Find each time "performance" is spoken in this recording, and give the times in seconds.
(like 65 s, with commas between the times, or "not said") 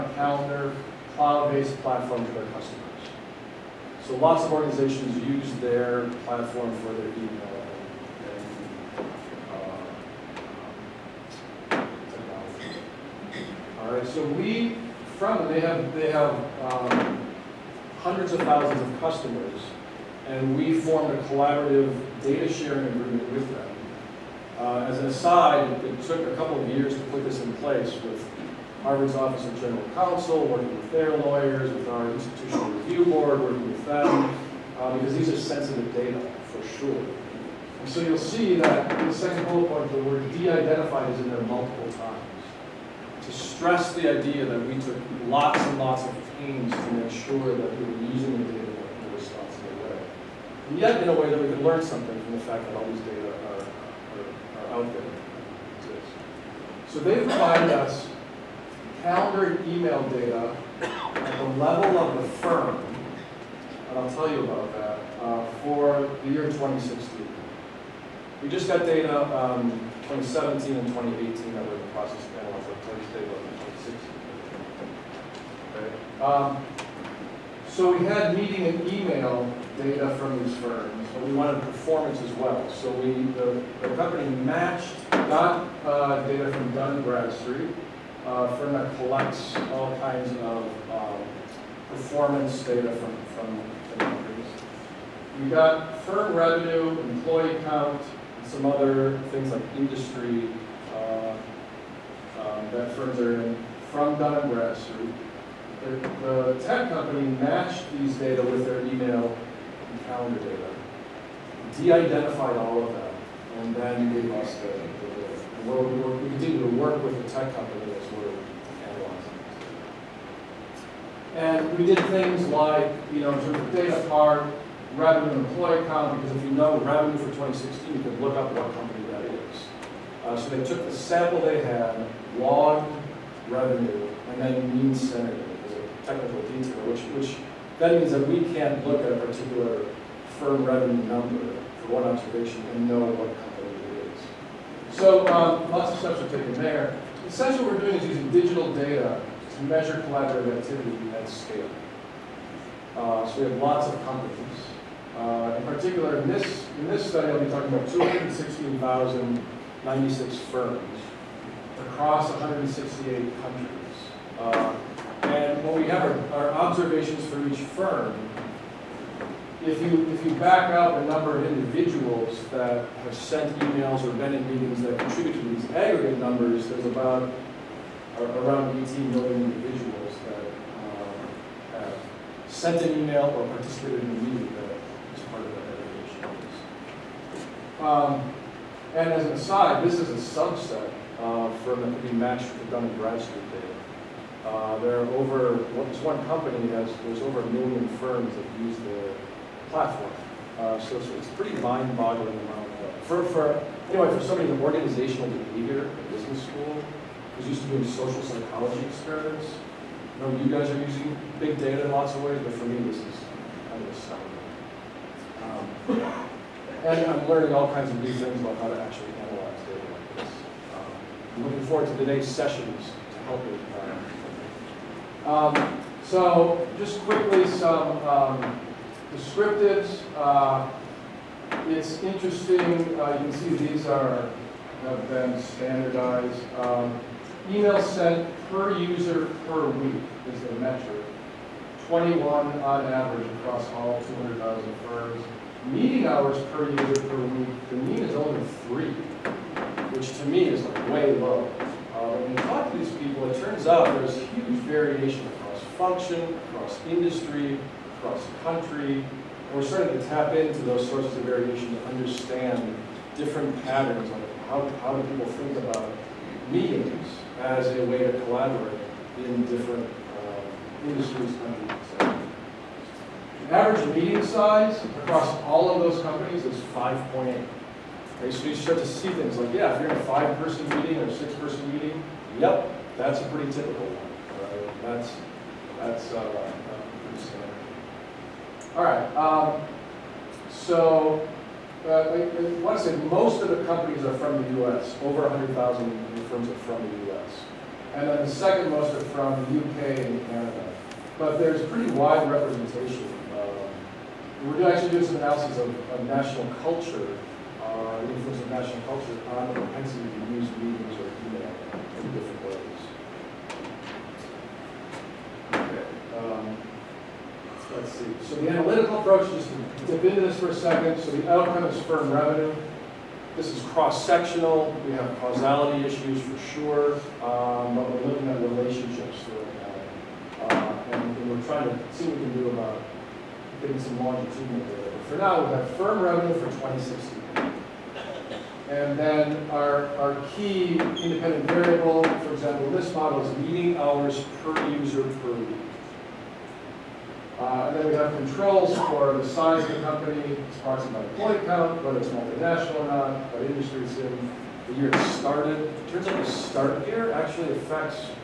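81 s, 91 s.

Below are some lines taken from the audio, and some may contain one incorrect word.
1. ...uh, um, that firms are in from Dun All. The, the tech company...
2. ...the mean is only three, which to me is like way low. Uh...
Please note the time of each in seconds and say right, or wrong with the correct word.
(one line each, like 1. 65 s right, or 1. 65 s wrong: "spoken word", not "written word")
1. 100 s wrong: "Bradstreet", not "All"
2. 247 s right.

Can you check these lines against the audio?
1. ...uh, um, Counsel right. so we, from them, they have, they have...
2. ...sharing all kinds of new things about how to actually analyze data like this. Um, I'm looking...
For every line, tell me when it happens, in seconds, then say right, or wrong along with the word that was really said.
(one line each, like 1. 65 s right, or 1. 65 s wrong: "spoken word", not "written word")
1. 11 s wrong: "All", not "Counsel"
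2. 217 s wrong: "learning", not "sharing".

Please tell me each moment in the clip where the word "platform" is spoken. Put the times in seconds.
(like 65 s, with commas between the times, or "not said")
1 s, 6 s, 199 s.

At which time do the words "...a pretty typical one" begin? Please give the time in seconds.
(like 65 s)
283 s.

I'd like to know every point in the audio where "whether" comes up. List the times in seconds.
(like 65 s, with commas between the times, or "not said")
351 s.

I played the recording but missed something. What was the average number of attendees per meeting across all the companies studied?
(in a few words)
5.8.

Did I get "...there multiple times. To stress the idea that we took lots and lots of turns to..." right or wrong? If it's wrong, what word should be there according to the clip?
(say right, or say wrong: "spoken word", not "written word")
wrong: "pains", not "turns".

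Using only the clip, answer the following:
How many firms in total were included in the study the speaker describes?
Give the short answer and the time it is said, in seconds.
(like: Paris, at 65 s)
216,096, at 157 s.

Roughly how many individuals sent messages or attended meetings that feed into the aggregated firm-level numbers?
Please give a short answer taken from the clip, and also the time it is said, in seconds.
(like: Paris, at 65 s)
18 million, at 178 s.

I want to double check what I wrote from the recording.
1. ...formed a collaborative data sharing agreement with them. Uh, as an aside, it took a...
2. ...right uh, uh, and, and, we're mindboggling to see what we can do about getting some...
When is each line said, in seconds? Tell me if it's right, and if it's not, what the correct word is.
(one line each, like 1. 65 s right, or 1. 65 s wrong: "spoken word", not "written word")
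1. 20 s right
2. 330 s wrong: "trying", not "mindboggling".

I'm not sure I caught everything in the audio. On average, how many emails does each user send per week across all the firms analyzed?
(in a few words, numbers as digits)
21.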